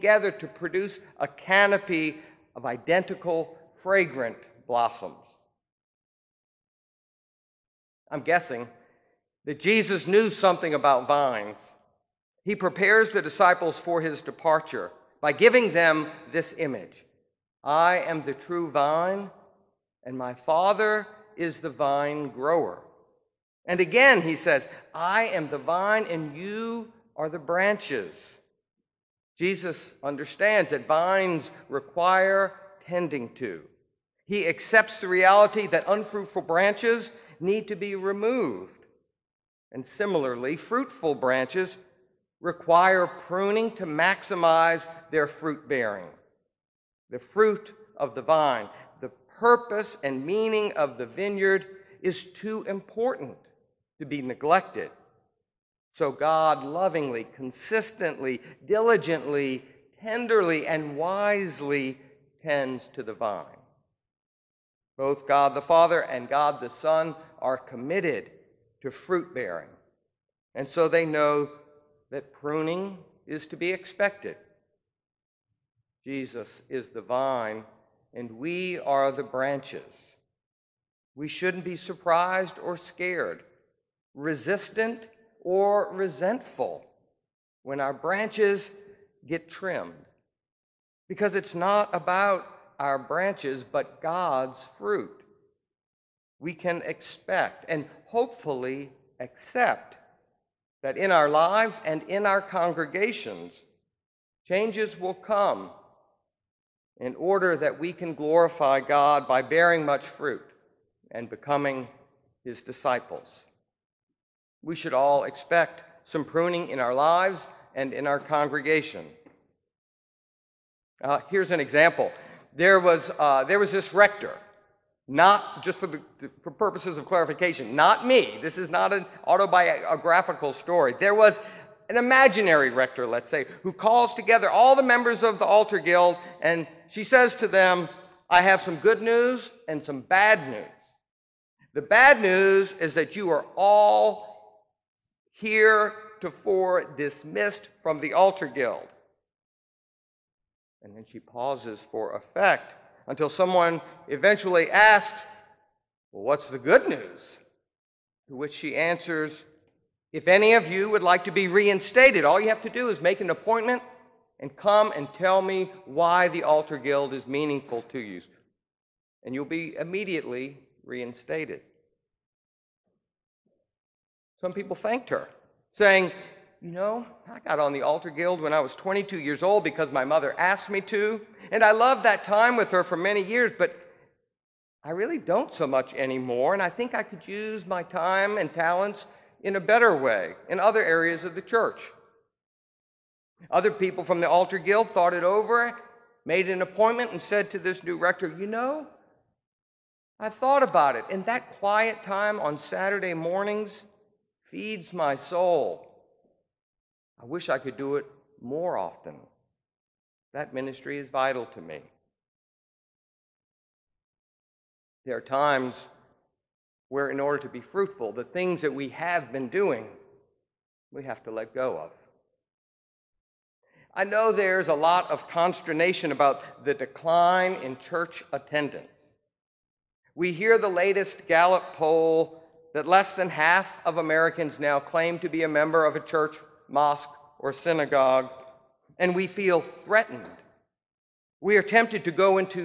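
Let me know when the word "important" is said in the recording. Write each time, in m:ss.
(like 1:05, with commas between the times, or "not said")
0:52.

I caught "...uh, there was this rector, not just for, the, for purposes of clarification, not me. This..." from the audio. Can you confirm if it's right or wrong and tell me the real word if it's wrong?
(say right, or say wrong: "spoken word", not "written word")
right.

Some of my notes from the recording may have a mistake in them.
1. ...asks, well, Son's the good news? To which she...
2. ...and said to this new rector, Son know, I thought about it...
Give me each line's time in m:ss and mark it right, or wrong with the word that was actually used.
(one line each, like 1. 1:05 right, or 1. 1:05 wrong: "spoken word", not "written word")
1. 2:34 wrong: "What", not "Son"
2. 3:17 wrong: "You", not "Son".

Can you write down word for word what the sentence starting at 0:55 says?
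So God lovingly, consistently, diligently, tenderly, and wisely tends to the vine.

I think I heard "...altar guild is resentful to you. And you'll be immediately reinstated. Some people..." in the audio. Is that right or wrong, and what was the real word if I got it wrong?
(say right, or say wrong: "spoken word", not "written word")
wrong: "meaningful", not "resentful".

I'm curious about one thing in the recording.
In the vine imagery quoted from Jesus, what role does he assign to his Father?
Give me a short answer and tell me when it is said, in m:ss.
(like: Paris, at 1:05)
The vine grower, at 0:21.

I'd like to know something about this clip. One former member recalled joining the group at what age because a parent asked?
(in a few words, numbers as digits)
22.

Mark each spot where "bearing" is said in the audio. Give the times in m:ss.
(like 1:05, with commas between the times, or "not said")
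0:45, 1:09, 1:49.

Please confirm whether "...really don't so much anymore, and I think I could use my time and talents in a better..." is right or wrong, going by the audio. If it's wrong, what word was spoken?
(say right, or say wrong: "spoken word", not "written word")
right.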